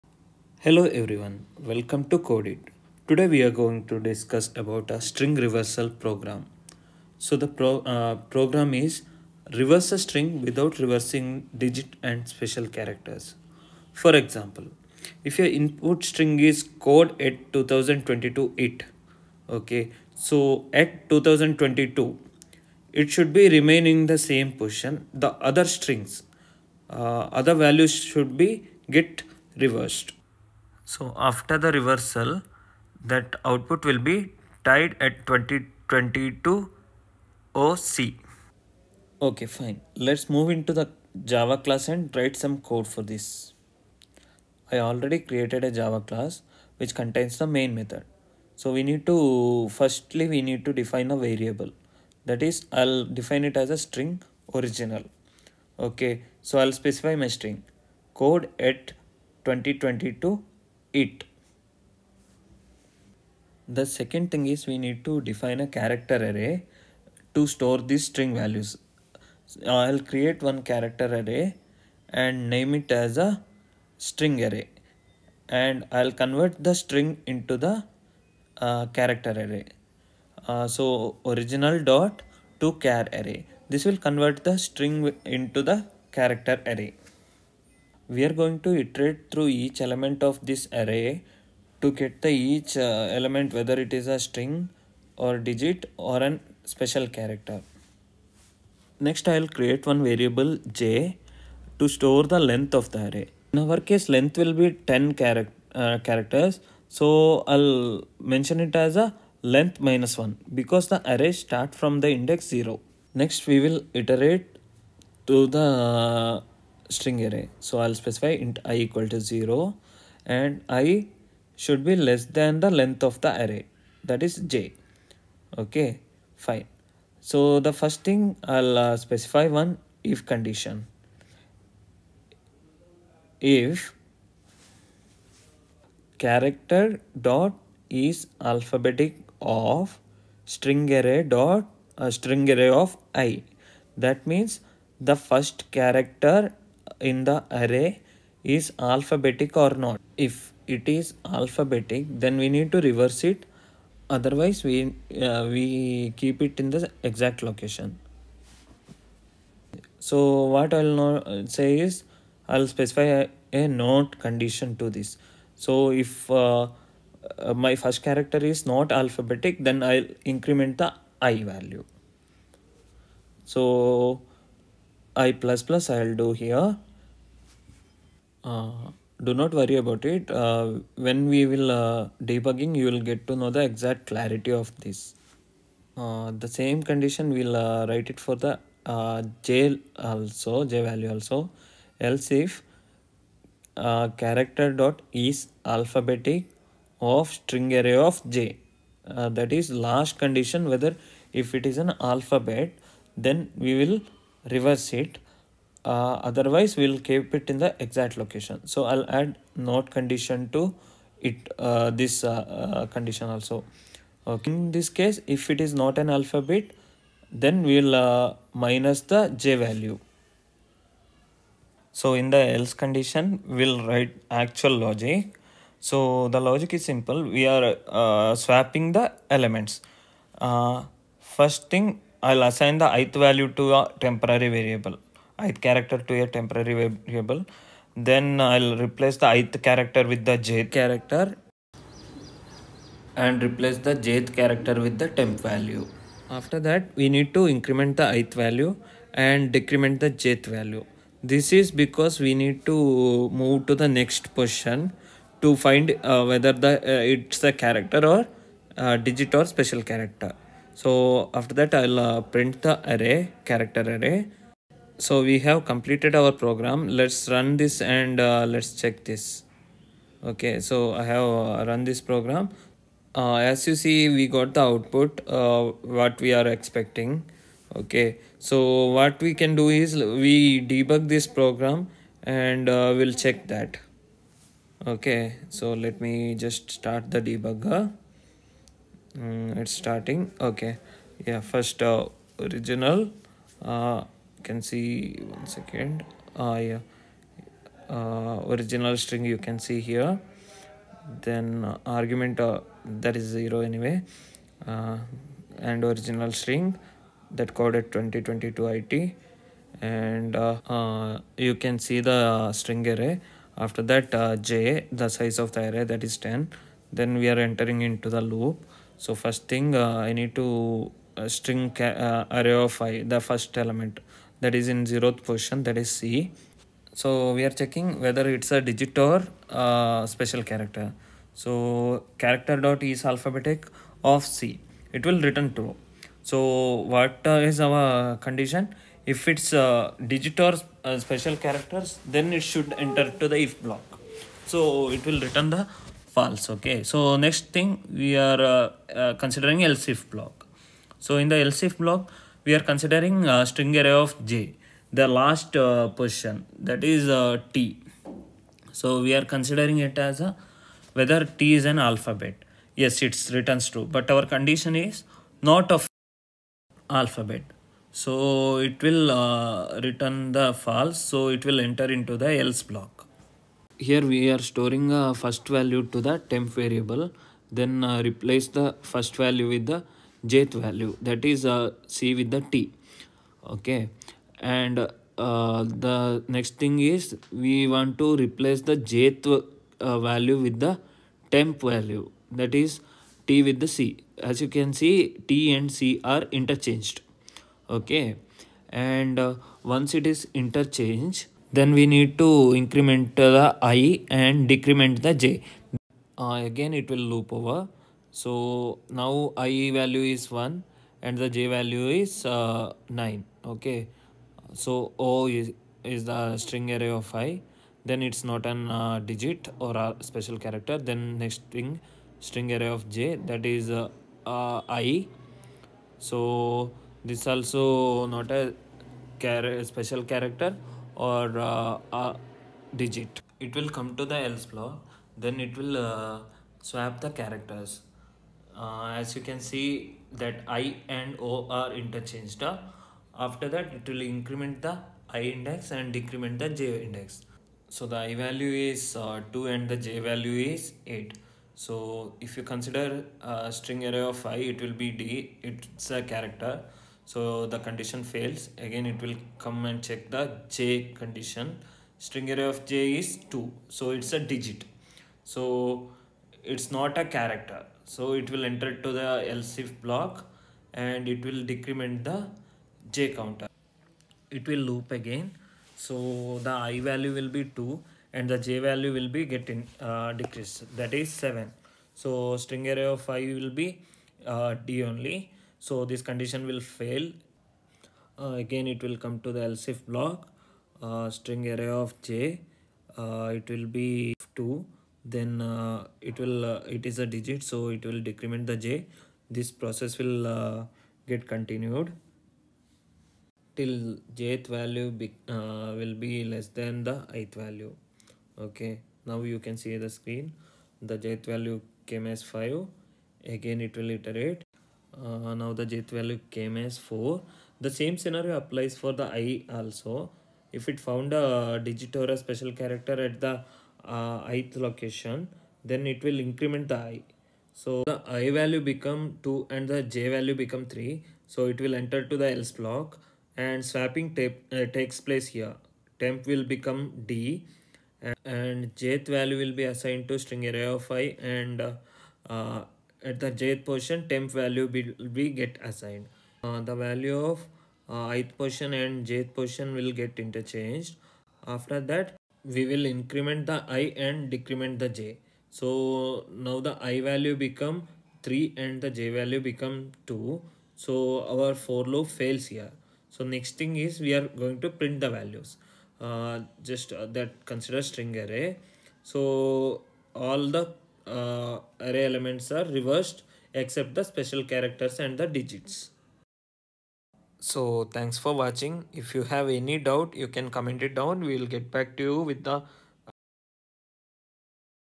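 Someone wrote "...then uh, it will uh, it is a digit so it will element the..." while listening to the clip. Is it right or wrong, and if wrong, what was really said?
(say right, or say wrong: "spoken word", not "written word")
wrong: "decrement", not "element".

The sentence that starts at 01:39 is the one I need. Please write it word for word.
Next I'll create one variable j to store the length of the array.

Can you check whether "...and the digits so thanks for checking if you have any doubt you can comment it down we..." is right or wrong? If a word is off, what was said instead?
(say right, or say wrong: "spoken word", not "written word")
wrong: "watching", not "checking".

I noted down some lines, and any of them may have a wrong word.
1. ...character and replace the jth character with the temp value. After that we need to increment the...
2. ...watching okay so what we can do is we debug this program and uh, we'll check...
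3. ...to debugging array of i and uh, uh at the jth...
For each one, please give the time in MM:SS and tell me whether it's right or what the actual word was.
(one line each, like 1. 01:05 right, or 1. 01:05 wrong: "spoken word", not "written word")
1. 04:00 right
2. 04:36 wrong: "expecting", not "watching"
3. 09:00 wrong: "string", not "debugging".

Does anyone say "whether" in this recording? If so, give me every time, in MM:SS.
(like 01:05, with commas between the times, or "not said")
01:33, 03:20, 04:16, 05:28, 06:00.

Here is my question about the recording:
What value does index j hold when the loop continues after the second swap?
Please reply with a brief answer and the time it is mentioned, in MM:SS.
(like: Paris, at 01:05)
8, at 07:30.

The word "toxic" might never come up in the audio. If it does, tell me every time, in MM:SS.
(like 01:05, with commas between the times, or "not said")
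not said.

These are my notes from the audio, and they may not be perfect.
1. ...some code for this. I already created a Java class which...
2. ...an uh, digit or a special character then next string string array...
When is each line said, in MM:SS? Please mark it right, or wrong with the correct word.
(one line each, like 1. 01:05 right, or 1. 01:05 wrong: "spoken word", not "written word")
1. 00:42 right
2. 06:58 right.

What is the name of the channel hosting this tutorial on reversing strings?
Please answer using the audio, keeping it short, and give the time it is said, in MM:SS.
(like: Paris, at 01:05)
CodeIt, at 00:02.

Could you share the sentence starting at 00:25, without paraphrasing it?
The other strings, uh, other values should be get reversed so after the reversal, that output will be tied at 2022 OC.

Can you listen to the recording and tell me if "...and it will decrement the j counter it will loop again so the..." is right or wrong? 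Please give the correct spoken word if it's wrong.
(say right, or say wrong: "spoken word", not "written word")
right.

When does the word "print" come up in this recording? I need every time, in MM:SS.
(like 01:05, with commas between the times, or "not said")
04:22, 09:24.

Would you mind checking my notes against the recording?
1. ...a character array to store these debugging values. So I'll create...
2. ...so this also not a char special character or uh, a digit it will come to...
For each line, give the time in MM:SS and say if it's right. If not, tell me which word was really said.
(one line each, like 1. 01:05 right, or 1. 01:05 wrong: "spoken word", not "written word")
1. 01:05 wrong: "string", not "debugging"
2. 07:05 right.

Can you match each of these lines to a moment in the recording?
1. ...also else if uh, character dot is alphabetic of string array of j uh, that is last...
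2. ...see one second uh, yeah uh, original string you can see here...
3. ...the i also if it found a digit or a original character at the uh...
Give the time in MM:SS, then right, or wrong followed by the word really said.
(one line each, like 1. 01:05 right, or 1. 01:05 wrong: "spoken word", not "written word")
1. 03:11 right
2. 04:54 right
3. 08:38 wrong: "special", not "original".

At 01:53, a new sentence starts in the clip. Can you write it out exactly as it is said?
Next we will iterate to the string array.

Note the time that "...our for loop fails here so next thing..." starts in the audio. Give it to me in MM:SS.
09:21.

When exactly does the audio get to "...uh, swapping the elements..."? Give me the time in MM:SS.
03:47.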